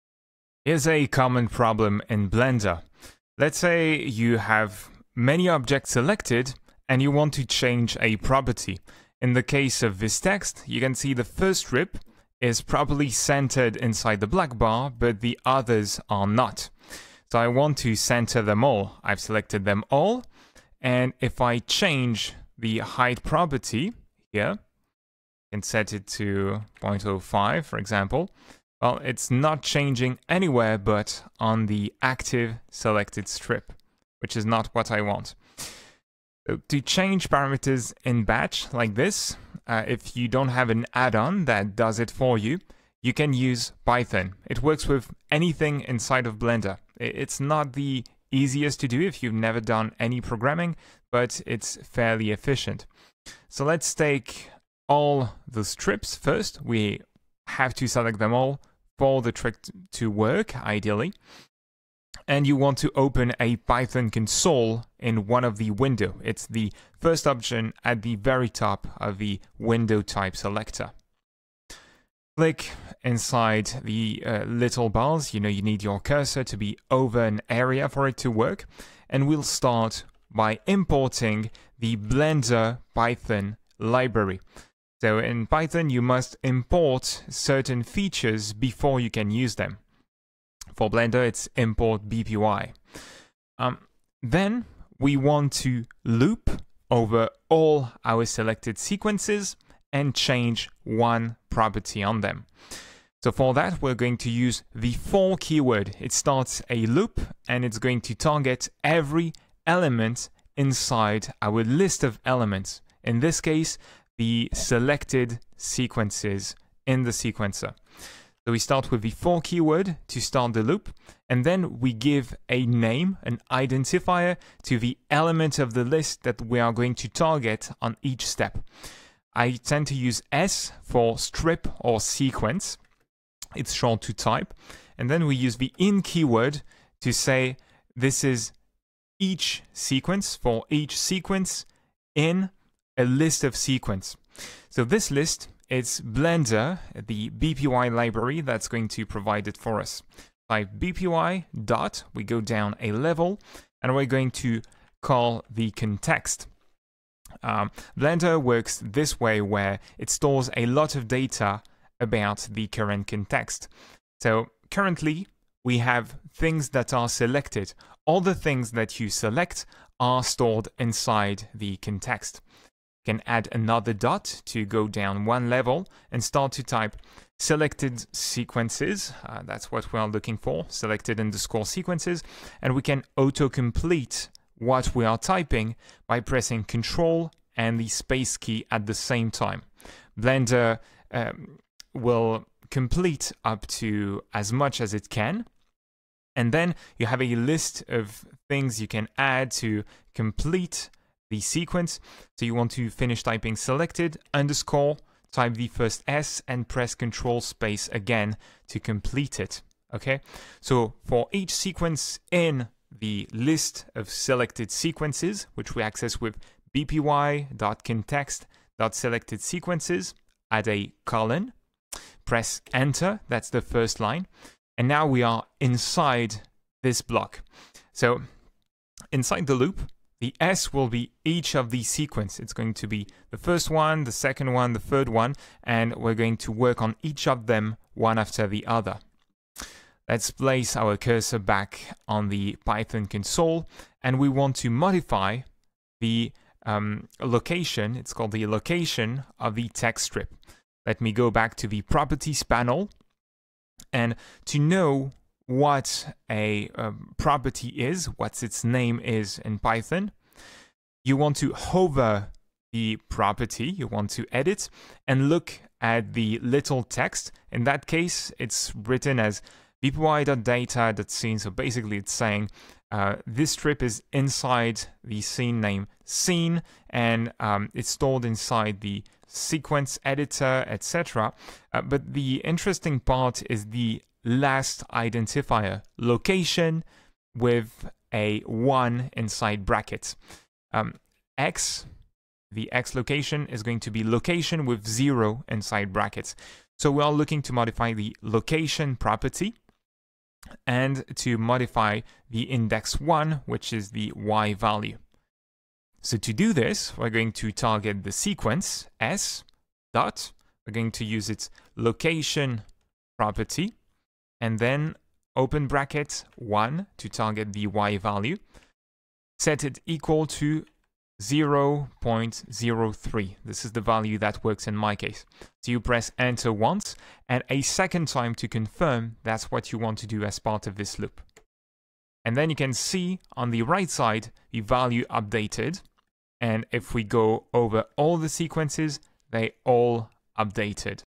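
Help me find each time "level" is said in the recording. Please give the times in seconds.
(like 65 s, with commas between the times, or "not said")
152 s, 175 s.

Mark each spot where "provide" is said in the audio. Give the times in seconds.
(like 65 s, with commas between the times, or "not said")
149 s.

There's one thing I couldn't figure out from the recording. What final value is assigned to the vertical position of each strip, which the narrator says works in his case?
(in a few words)
0.03.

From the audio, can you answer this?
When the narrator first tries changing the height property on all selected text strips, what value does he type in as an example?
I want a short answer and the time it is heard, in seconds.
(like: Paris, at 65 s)
0.05, at 26 s.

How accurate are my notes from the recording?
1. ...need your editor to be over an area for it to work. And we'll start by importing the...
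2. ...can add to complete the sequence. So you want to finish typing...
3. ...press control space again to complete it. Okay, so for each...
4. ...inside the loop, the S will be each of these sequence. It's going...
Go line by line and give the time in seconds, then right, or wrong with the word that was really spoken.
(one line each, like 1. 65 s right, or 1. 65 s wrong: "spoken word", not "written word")
1. 75 s wrong: "cursor", not "editor"
2. 198 s right
3. 206 s right
4. 229 s right.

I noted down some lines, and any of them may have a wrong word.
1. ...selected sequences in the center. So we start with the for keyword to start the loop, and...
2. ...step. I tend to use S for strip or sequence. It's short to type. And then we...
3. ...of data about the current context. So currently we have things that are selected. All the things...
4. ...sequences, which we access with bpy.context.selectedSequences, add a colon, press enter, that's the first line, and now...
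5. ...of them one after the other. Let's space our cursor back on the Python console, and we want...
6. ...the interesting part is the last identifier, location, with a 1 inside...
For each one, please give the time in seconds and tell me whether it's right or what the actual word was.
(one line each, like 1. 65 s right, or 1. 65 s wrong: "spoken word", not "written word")
1. 114 s wrong: "sequencer", not "center"
2. 128 s right
3. 160 s right
4. 214 s right
5. 237 s wrong: "place", not "space"
6. 282 s right.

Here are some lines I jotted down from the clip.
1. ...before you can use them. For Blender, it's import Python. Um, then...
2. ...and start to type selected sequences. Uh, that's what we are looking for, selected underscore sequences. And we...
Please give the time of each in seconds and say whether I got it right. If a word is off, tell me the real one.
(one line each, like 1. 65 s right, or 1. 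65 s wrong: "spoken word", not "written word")
1. 88 s wrong: "BPY", not "Python"
2. 176 s right.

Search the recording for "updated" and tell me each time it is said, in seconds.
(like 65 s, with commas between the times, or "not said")
335 s, 340 s.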